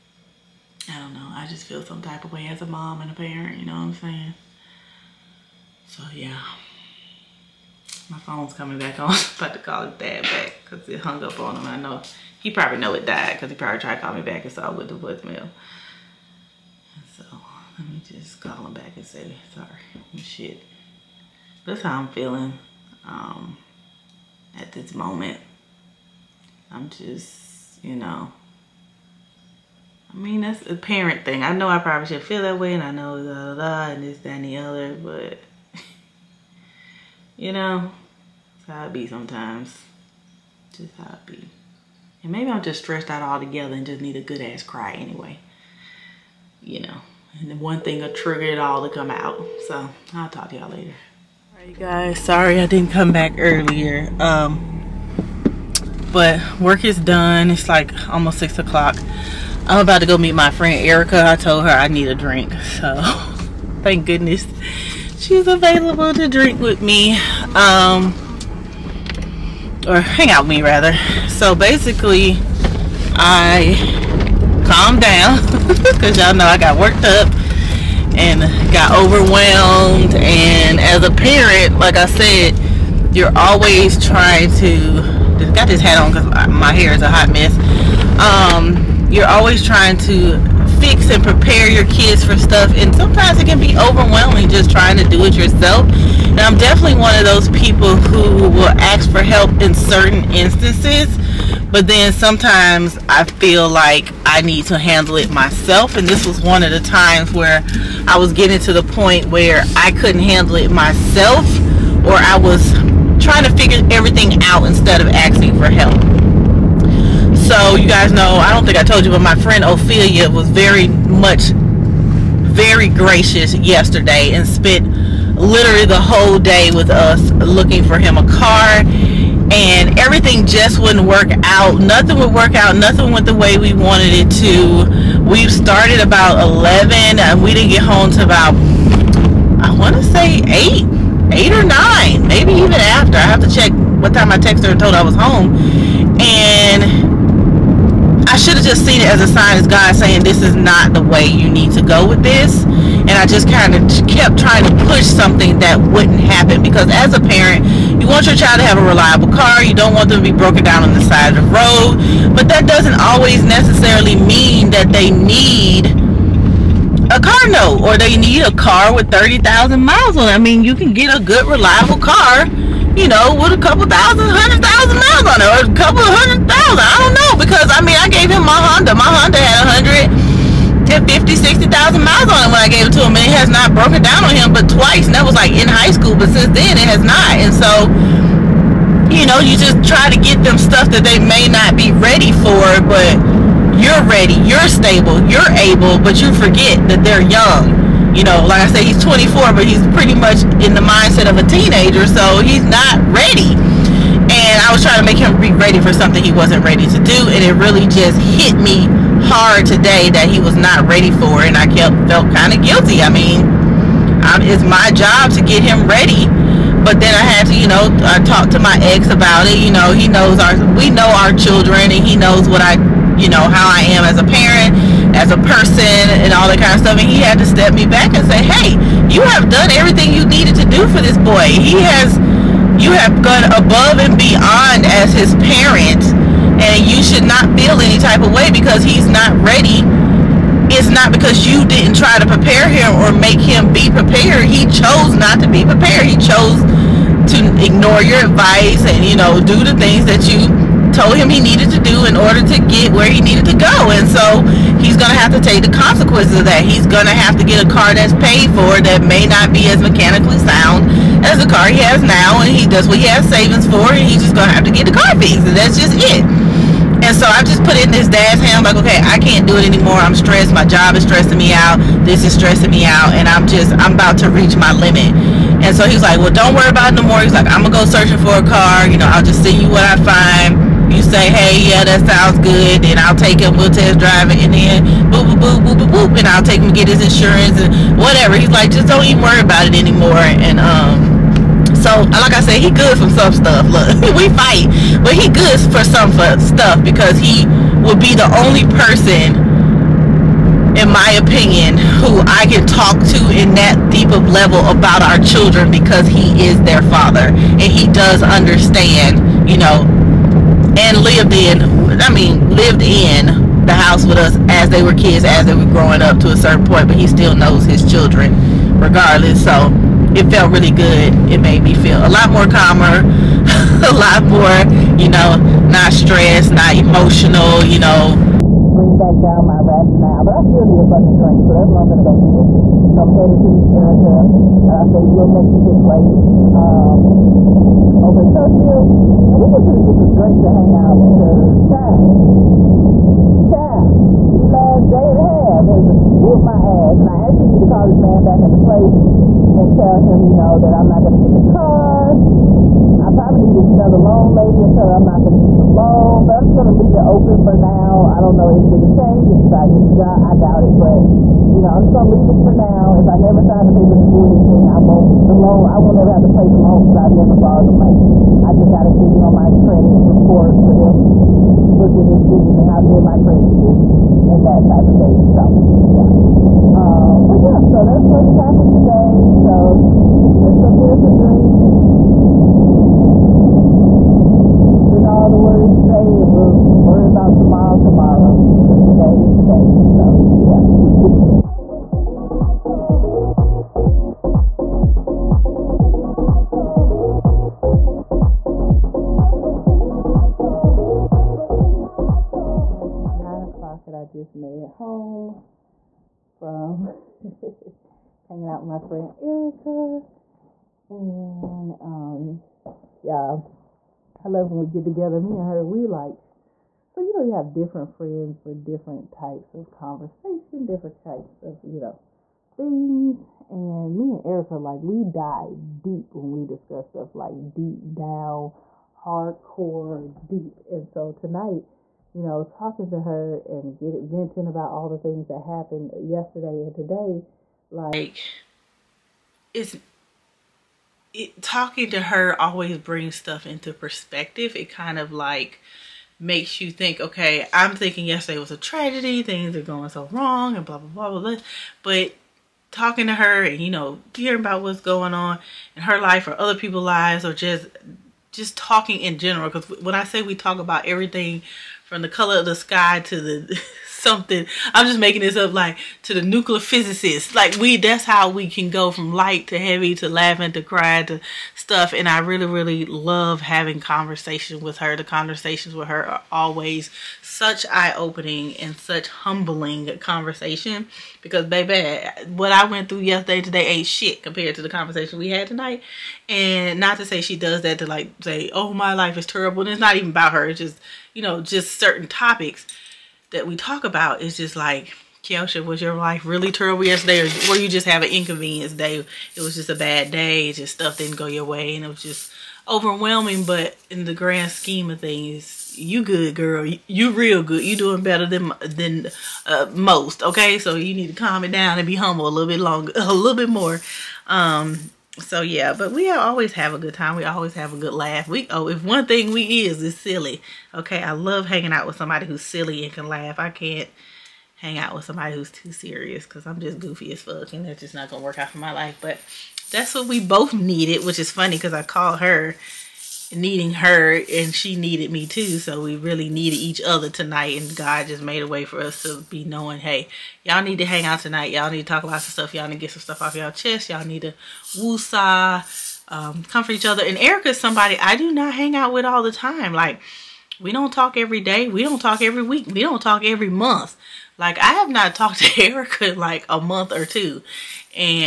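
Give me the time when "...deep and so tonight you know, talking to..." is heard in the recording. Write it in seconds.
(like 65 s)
430 s.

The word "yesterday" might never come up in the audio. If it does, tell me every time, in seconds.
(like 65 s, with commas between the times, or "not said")
123 s, 435 s, 448 s, 482 s, 496 s.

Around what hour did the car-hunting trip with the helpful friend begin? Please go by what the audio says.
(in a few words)
11.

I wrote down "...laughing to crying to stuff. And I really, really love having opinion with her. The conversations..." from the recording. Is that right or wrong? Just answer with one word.
wrong.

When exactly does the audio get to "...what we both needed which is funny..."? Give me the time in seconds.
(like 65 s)
529 s.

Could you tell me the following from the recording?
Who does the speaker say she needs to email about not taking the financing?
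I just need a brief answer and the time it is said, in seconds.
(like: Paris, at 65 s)
the loan lady, at 353 s.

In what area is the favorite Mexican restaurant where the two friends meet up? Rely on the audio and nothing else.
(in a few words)
Trussville.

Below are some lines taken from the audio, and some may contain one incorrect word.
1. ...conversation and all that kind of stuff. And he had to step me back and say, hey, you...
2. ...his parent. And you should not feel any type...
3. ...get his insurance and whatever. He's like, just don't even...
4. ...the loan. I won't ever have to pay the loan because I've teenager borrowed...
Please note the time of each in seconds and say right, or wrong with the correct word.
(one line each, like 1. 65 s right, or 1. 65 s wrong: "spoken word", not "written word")
1. 225 s wrong: "person", not "conversation"
2. 235 s right
3. 286 s right
4. 365 s wrong: "never", not "teenager".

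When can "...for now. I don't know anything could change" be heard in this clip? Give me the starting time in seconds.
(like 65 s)
357 s.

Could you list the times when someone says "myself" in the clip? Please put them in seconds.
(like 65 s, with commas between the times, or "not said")
105 s, 110 s.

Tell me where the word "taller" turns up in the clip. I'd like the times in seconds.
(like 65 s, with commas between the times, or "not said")
not said.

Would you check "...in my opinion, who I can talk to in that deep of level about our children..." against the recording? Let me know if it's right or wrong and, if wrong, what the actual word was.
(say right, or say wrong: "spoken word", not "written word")
right.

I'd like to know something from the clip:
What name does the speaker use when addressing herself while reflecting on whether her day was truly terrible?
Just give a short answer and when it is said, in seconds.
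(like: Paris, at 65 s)
Keoshia, at 495 s.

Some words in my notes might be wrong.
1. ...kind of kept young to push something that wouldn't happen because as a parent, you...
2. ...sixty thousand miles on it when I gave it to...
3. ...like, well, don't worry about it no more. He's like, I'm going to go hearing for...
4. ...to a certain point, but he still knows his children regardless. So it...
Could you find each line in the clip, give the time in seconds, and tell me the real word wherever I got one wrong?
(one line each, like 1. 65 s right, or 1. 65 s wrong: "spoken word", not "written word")
1. 153 s wrong: "trying", not "young"
2. 181 s right
3. 276 s wrong: "searching", not "hearing"
4. 316 s right.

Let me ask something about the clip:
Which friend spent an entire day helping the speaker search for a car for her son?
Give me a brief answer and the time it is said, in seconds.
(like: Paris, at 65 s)
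Ophelia, at 119 s.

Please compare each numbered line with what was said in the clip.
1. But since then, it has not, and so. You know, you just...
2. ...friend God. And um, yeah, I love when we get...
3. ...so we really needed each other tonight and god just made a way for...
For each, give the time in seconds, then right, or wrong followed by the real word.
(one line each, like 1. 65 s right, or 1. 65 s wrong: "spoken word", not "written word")
1. 186 s right
2. 408 s wrong: "Erica", not "God"
3. 535 s right.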